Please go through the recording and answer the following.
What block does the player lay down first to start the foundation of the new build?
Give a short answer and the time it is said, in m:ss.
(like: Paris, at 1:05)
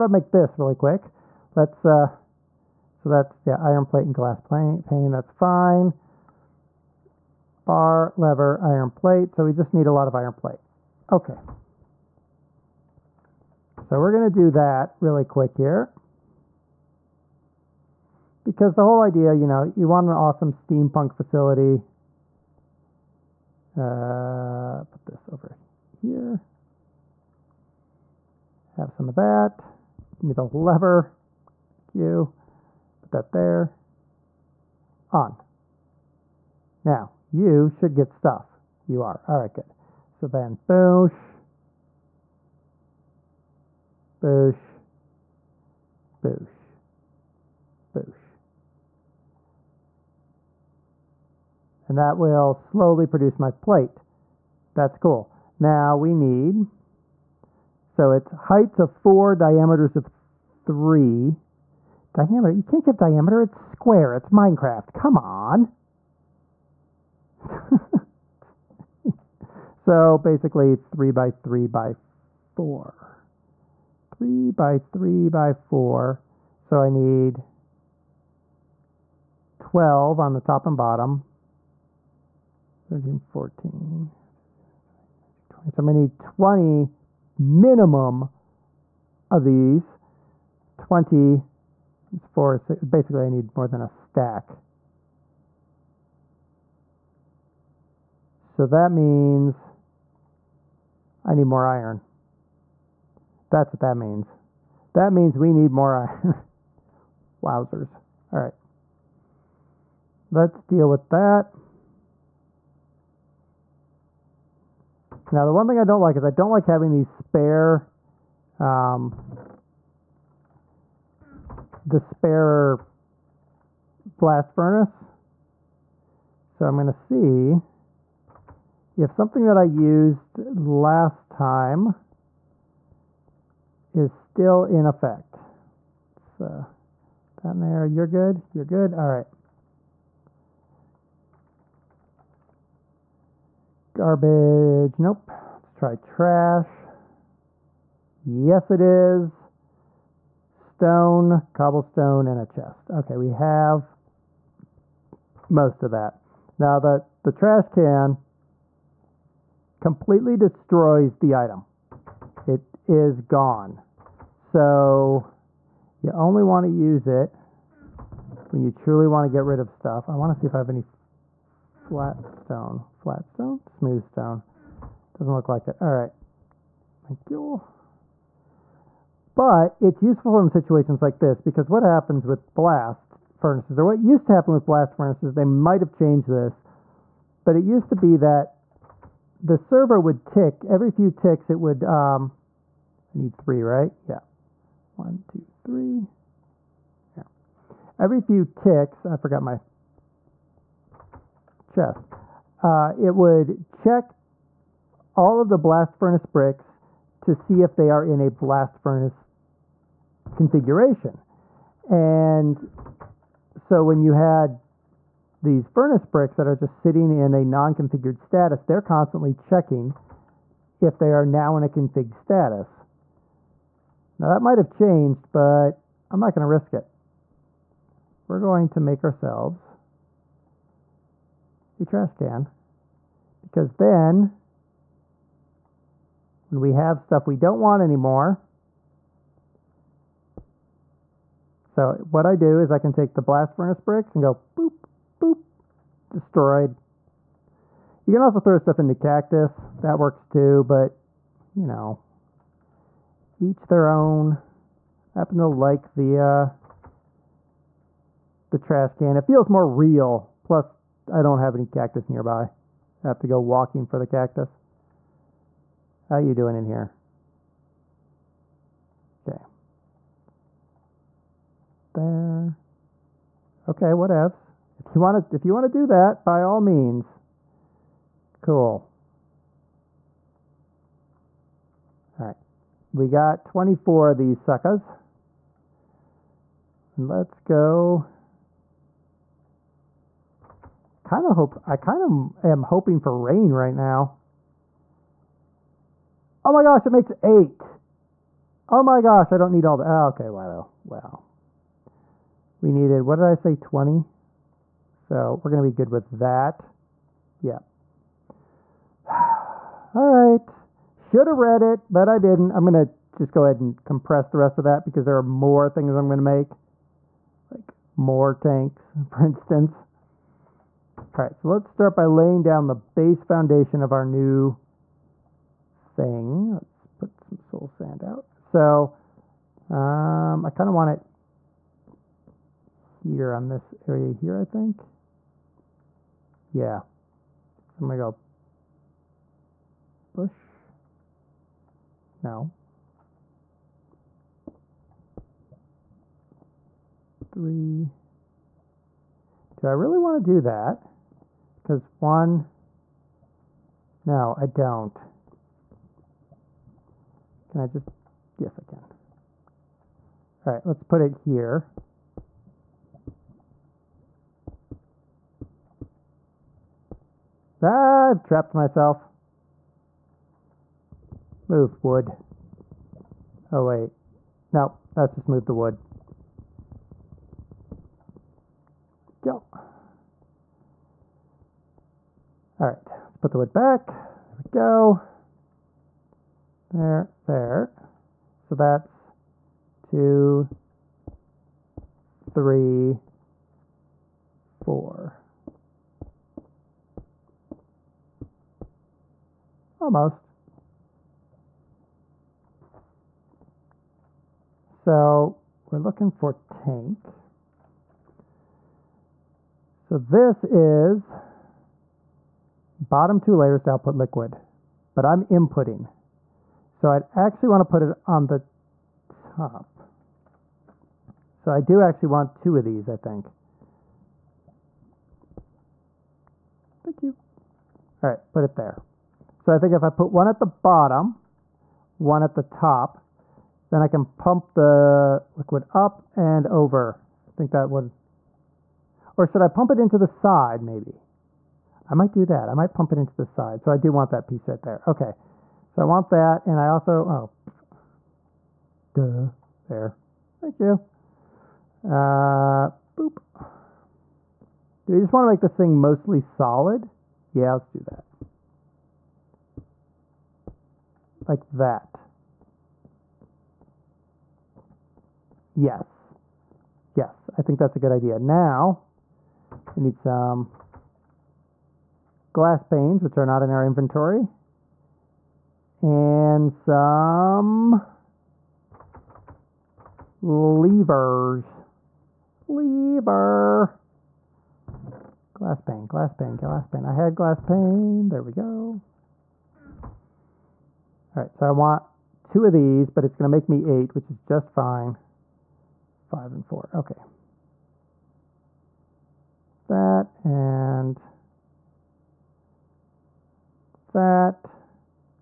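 soul sand, at 5:27.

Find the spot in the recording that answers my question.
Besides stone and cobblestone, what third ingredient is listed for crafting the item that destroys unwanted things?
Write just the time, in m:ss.
2:32.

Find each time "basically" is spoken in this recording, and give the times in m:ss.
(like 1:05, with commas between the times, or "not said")
1:10, 1:32.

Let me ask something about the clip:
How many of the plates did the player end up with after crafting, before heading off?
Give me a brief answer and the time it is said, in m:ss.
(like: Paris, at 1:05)
24, at 4:42.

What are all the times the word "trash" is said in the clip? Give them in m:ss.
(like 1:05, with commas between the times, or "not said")
2:25, 2:37, 3:51, 4:18.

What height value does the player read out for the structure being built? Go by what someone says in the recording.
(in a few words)
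4.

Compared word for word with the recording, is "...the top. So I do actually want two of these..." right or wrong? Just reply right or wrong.
right.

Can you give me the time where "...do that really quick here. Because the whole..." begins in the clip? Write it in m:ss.
0:14.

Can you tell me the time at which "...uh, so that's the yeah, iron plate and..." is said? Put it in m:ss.
0:01.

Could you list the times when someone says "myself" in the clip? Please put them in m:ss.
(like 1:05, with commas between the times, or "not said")
6:08.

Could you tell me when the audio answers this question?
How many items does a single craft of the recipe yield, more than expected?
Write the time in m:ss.
4:56.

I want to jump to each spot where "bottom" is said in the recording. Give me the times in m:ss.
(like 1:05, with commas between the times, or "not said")
1:20, 6:52, 7:10.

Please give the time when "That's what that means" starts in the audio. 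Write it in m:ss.
1:43.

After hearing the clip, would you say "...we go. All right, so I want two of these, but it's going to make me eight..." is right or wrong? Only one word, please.
right.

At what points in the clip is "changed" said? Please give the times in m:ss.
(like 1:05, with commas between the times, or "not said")
3:05, 3:44.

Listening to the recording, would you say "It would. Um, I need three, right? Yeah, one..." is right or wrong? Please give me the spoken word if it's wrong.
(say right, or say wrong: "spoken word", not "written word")
right.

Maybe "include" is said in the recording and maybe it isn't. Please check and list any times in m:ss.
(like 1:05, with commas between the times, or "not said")
not said.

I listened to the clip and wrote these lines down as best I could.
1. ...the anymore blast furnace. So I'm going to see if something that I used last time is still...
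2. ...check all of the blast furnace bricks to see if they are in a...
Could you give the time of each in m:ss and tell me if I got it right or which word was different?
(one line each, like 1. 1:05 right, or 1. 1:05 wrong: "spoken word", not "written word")
1. 2:01 wrong: "spare", not "anymore"
2. 3:23 right.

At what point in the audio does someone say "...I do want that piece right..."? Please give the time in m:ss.
7:23.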